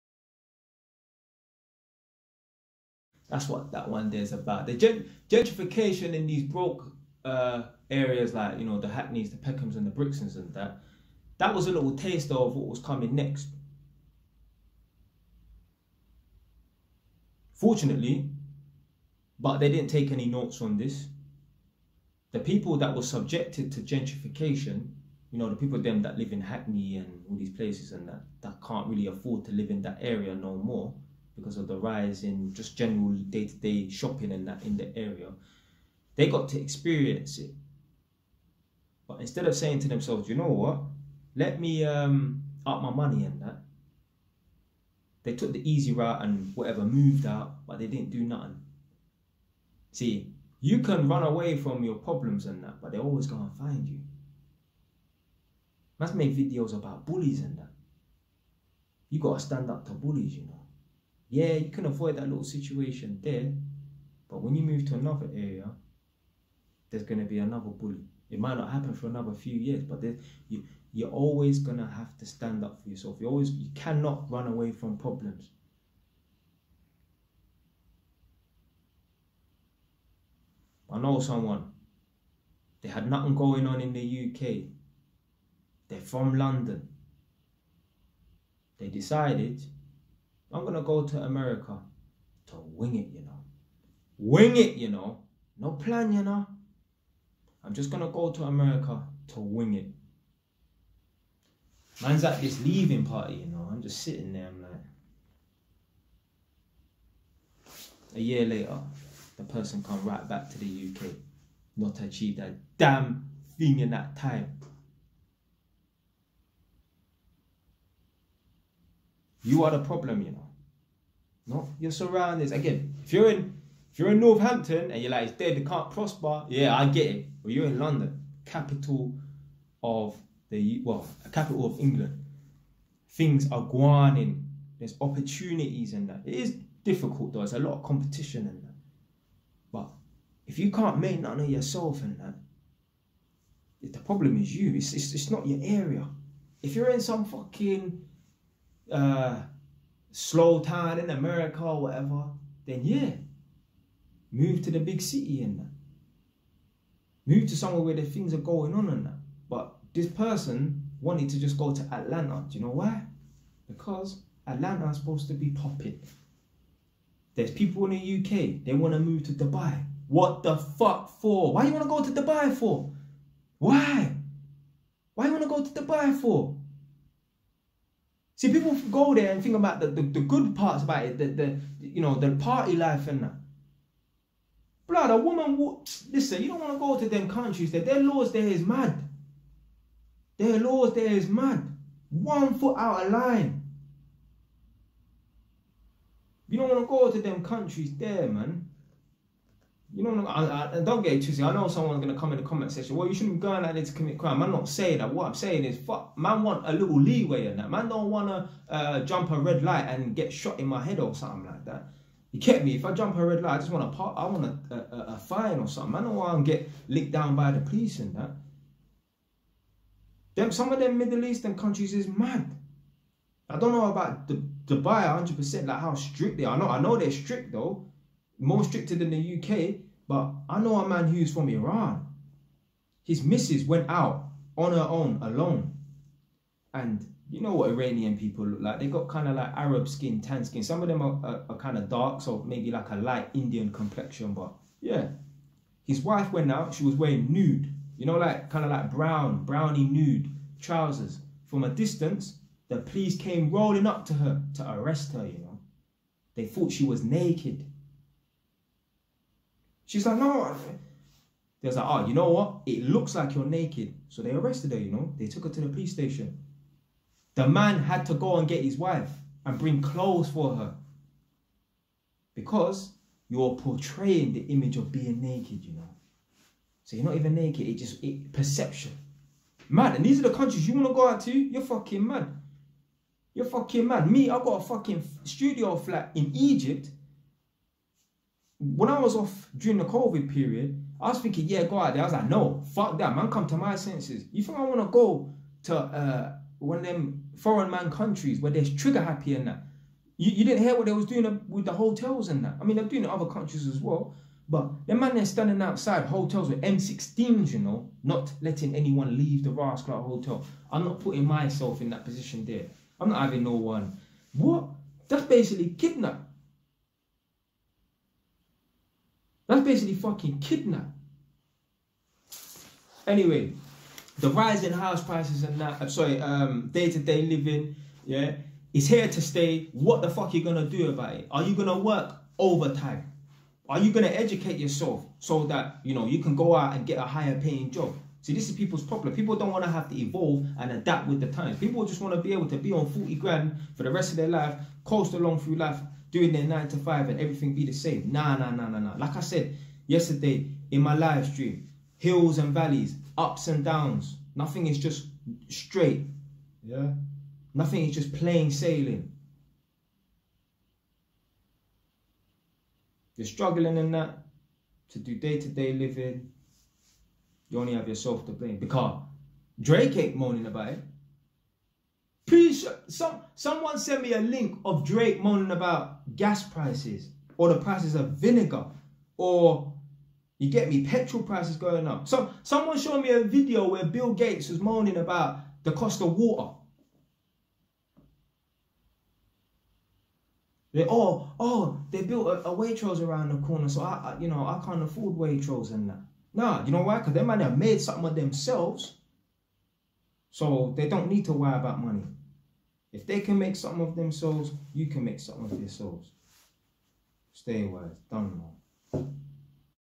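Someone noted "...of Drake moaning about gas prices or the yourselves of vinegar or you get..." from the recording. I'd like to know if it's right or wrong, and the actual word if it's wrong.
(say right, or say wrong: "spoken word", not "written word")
wrong: "prices", not "yourselves".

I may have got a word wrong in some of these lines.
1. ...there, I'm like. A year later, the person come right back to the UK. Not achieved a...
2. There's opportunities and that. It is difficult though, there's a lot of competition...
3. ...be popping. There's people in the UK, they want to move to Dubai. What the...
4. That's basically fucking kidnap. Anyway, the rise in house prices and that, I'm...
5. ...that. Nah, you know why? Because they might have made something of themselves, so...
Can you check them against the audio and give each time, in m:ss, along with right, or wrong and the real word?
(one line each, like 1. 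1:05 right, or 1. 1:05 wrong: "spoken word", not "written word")
1. 1:44 right
2. 2:14 right
3. 2:45 right
4. 5:19 right
5. 6:35 right.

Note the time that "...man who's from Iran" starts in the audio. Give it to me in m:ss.
3:50.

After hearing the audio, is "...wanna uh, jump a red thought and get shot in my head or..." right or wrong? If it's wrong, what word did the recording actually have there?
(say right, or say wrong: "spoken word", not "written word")
wrong: "light", not "thought".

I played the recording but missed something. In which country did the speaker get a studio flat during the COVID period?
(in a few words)
Egypt.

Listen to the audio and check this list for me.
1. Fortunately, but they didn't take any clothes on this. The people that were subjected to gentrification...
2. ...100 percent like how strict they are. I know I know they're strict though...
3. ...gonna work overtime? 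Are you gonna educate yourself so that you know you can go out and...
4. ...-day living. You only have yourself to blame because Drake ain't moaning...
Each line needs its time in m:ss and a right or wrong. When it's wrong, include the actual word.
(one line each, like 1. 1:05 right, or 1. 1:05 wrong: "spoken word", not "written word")
1. 0:17 wrong: "notes", not "clothes"
2. 3:45 right
3. 5:31 right
4. 6:05 right.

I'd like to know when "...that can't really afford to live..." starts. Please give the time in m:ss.
0:28.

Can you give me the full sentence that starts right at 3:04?
Blood, a woman listen, you don't want to go to them countries there.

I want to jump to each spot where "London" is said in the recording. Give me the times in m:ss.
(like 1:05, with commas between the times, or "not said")
1:26, 2:07.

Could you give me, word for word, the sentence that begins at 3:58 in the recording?
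They got kind of like Arab skin, tan skin.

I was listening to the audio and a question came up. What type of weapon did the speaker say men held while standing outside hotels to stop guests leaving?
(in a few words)
M16s.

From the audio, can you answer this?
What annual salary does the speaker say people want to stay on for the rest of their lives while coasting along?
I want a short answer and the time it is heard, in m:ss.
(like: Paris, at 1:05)
40 grand, at 5:42.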